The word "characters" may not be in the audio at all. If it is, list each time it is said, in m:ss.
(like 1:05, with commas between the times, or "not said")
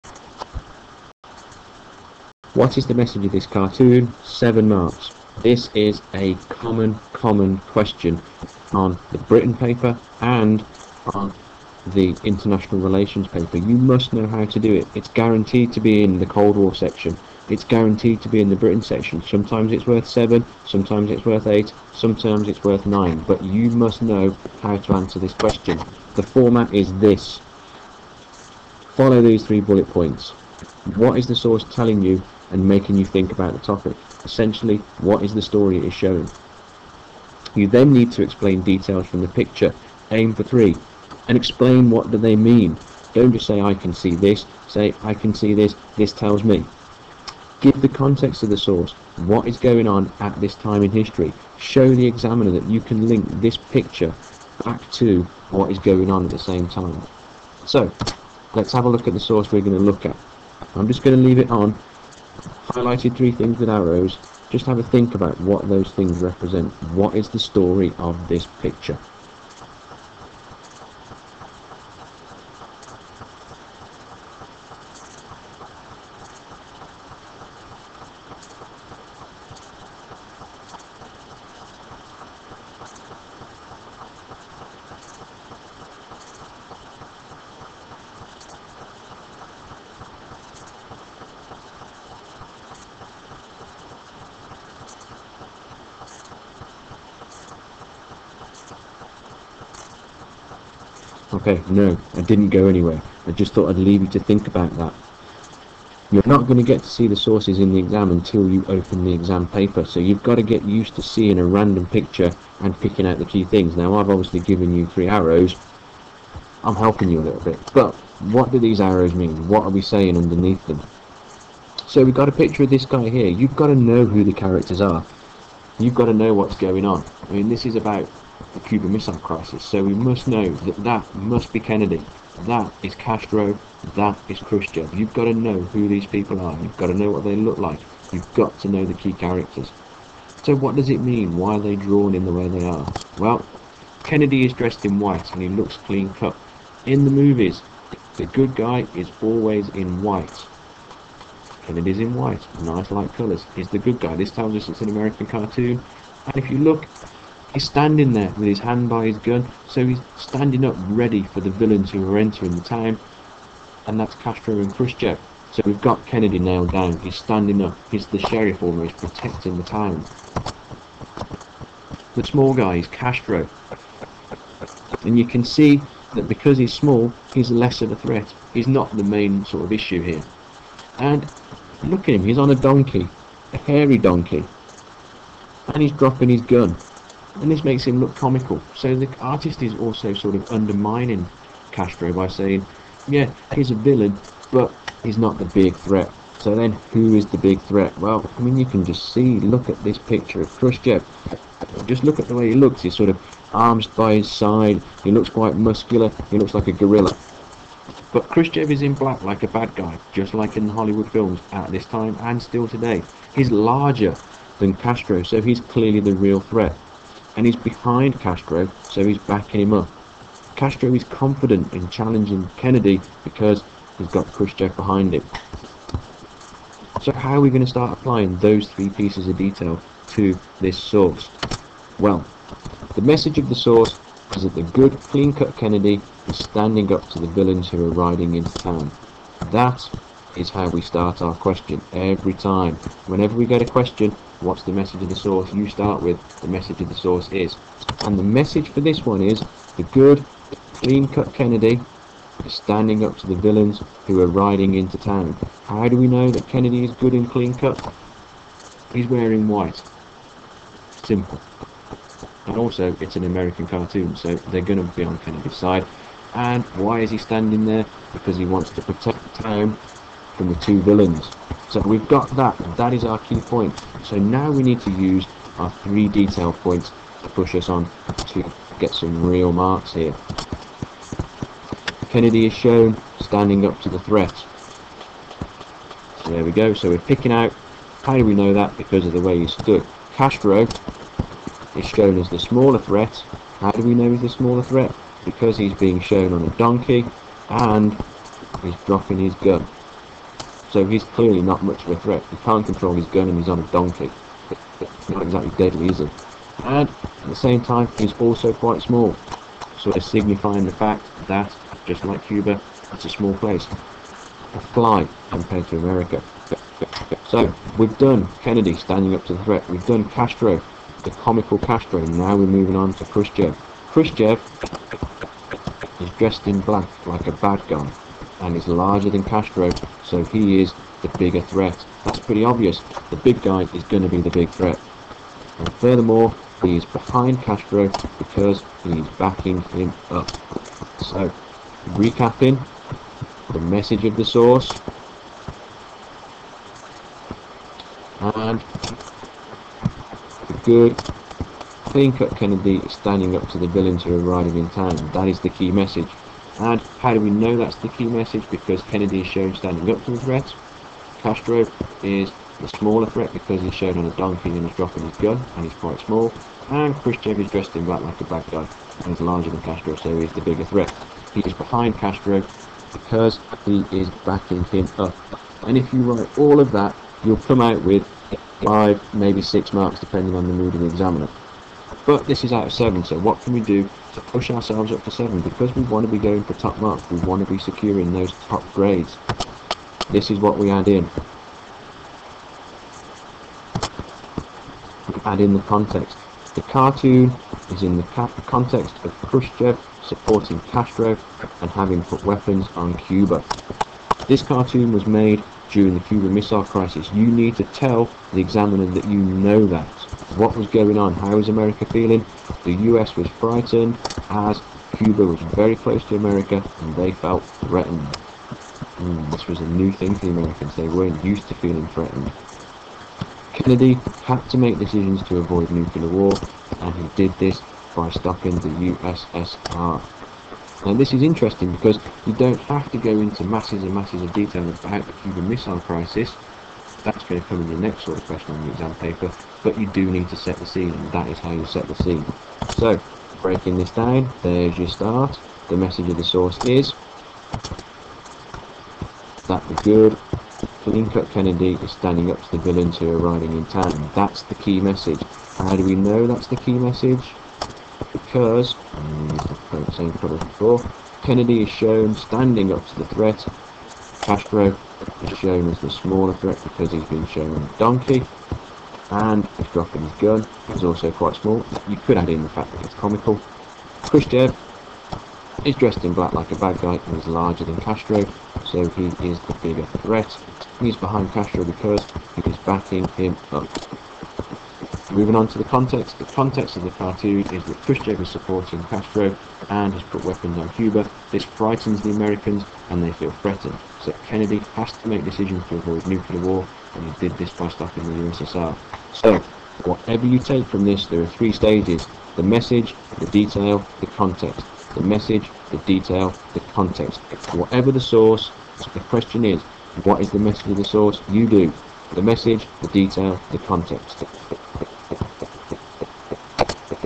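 2:04, 2:19.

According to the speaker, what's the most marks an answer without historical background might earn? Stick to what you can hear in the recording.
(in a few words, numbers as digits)
6.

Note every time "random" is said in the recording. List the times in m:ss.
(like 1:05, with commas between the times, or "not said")
1:51.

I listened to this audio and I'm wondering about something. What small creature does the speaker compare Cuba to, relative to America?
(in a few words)
A fly.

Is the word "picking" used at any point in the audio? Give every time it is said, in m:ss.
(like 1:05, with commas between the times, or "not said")
1:52, 4:46.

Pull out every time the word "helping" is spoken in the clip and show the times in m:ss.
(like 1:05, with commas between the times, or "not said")
1:56.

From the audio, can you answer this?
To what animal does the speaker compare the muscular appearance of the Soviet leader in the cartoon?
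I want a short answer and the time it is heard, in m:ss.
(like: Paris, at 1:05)
Gorilla, at 3:26.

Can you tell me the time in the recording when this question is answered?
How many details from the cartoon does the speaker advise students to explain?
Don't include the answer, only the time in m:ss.
0:40.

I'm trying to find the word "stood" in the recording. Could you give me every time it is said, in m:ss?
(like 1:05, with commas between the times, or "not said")
4:49.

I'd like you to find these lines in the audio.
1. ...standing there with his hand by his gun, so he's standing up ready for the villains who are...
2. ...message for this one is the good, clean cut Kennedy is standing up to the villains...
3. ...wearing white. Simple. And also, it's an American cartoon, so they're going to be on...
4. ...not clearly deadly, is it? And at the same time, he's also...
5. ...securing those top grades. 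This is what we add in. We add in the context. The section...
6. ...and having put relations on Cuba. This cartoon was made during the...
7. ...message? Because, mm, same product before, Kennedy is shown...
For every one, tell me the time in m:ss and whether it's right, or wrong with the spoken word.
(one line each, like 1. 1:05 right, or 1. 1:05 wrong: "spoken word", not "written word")
1. 2:37 right
2. 4:08 right
3. 4:19 right
4. 5:05 wrong: "exactly", not "clearly"
5. 6:27 wrong: "cartoon", not "section"
6. 6:41 wrong: "weapons", not "relations"
7. 7:36 right.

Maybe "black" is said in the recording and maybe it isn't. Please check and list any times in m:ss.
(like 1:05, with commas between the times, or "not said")
3:28, 5:26, 6:07, 7:56.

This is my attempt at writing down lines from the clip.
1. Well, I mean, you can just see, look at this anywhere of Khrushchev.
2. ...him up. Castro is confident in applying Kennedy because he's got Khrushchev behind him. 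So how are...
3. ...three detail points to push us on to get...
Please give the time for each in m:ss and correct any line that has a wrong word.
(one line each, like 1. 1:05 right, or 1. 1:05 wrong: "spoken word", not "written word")
1. 3:17 wrong: "picture", not "anywhere"
2. 3:39 wrong: "challenging", not "applying"
3. 4:35 right.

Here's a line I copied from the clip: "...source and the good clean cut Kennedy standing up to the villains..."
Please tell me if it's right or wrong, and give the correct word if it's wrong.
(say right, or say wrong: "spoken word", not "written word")
right.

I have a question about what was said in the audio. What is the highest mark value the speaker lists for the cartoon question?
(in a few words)
9.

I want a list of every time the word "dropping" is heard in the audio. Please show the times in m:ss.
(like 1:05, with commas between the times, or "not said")
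3:05, 4:58, 6:04, 7:49.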